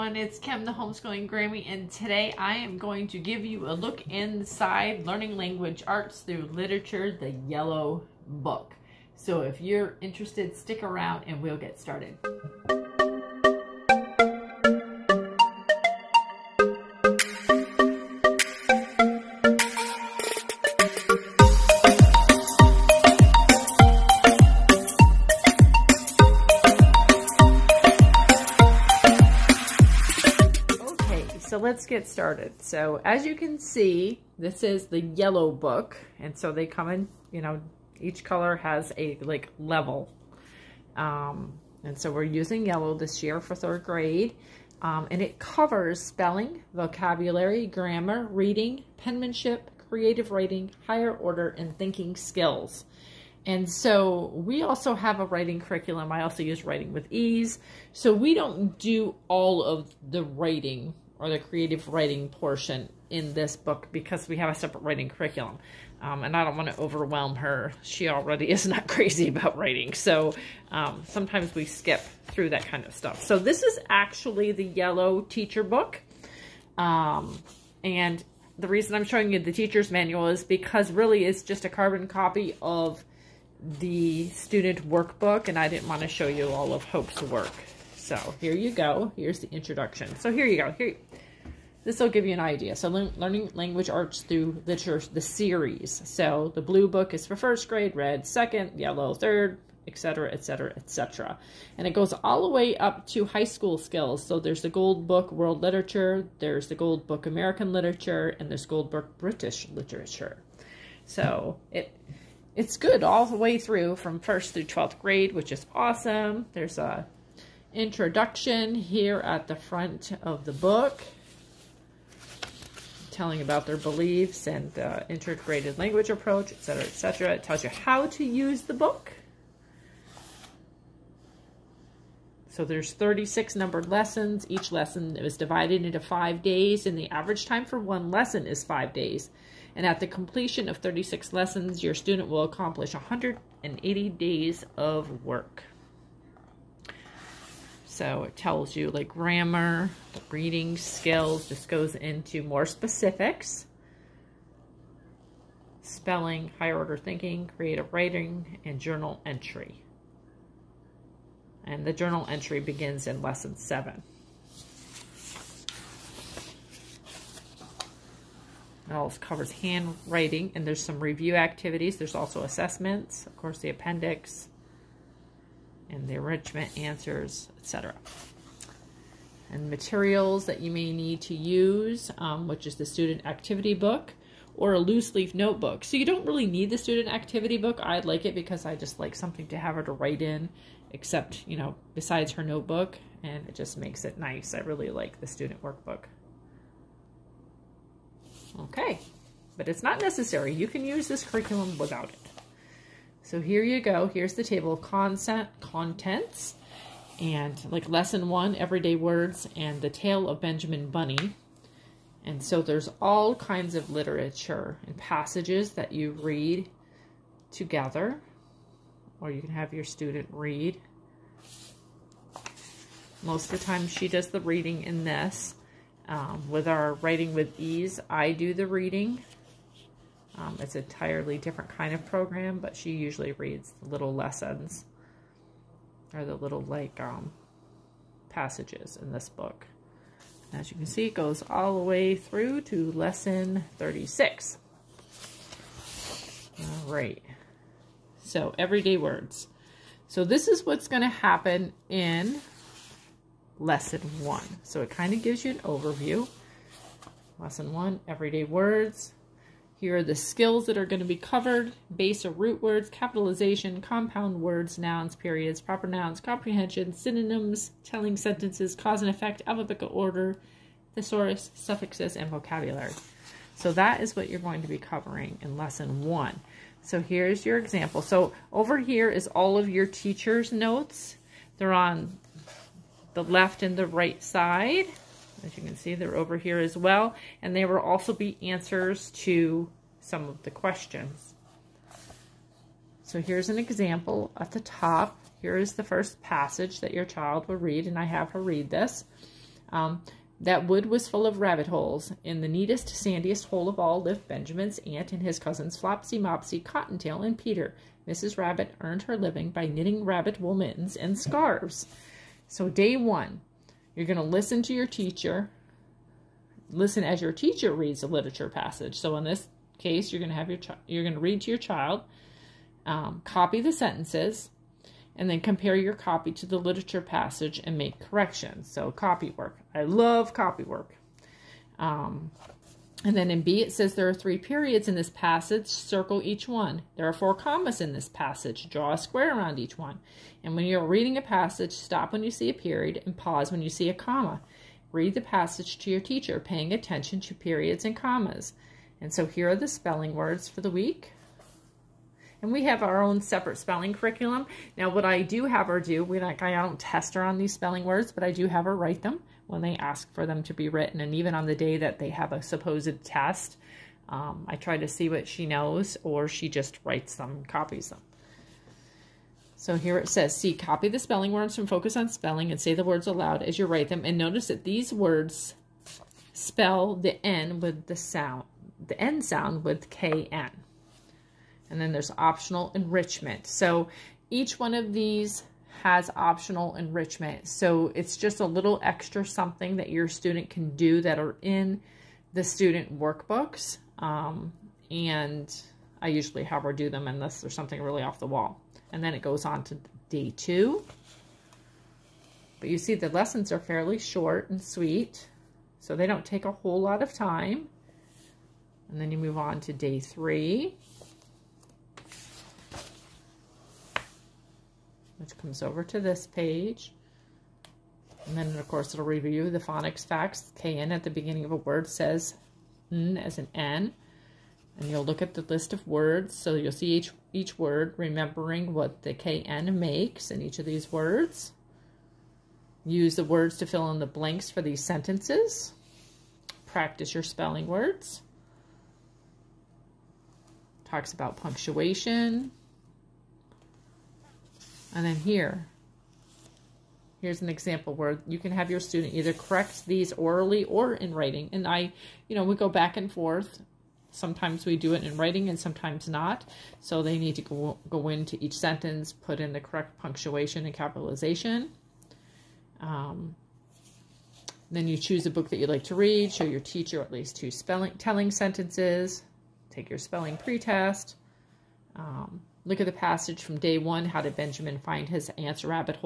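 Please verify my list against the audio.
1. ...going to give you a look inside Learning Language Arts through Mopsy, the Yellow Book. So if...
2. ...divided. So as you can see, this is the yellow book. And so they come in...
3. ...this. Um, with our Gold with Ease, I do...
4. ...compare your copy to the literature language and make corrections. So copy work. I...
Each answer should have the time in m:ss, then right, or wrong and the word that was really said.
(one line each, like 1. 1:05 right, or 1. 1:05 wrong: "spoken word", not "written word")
1. 0:02 wrong: "Literature", not "Mopsy"
2. 0:32 wrong: "started", not "divided"
3. 3:45 wrong: "Writing", not "Gold"
4. 5:25 wrong: "passage", not "language".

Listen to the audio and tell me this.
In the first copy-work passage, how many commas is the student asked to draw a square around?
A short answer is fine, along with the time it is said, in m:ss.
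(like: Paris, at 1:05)
4, at 5:37.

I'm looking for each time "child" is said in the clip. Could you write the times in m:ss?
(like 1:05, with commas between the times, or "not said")
4:57, 5:21.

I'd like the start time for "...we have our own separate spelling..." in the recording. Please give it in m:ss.
5:52.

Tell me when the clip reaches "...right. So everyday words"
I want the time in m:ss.
4:06.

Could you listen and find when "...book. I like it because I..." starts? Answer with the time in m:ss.
3:07.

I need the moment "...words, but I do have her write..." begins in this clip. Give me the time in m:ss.
5:57.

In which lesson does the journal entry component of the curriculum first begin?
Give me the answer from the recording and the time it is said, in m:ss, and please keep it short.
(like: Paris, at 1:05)
lesson 7, at 2:43.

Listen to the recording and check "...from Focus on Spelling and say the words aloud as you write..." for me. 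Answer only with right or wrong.
right.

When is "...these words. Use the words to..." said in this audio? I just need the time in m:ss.
7:10.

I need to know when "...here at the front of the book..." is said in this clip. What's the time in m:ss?
1:58.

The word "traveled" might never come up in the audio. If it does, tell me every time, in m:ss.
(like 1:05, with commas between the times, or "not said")
not said.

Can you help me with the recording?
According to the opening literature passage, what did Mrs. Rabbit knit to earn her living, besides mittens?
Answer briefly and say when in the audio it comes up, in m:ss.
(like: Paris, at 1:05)
scarves, at 5:11.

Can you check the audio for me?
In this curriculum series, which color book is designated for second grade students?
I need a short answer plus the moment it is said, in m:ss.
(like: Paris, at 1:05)
red, at 1:37.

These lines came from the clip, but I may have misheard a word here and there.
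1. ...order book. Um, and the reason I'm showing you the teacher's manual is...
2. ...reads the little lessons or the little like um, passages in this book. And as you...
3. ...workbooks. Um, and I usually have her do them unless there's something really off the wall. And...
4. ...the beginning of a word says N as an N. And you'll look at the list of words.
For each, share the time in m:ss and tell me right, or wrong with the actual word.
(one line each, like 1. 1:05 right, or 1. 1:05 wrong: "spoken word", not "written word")
1. 1:15 wrong: "teacher", not "order"
2. 3:53 right
3. 6:32 right
4. 7:01 right.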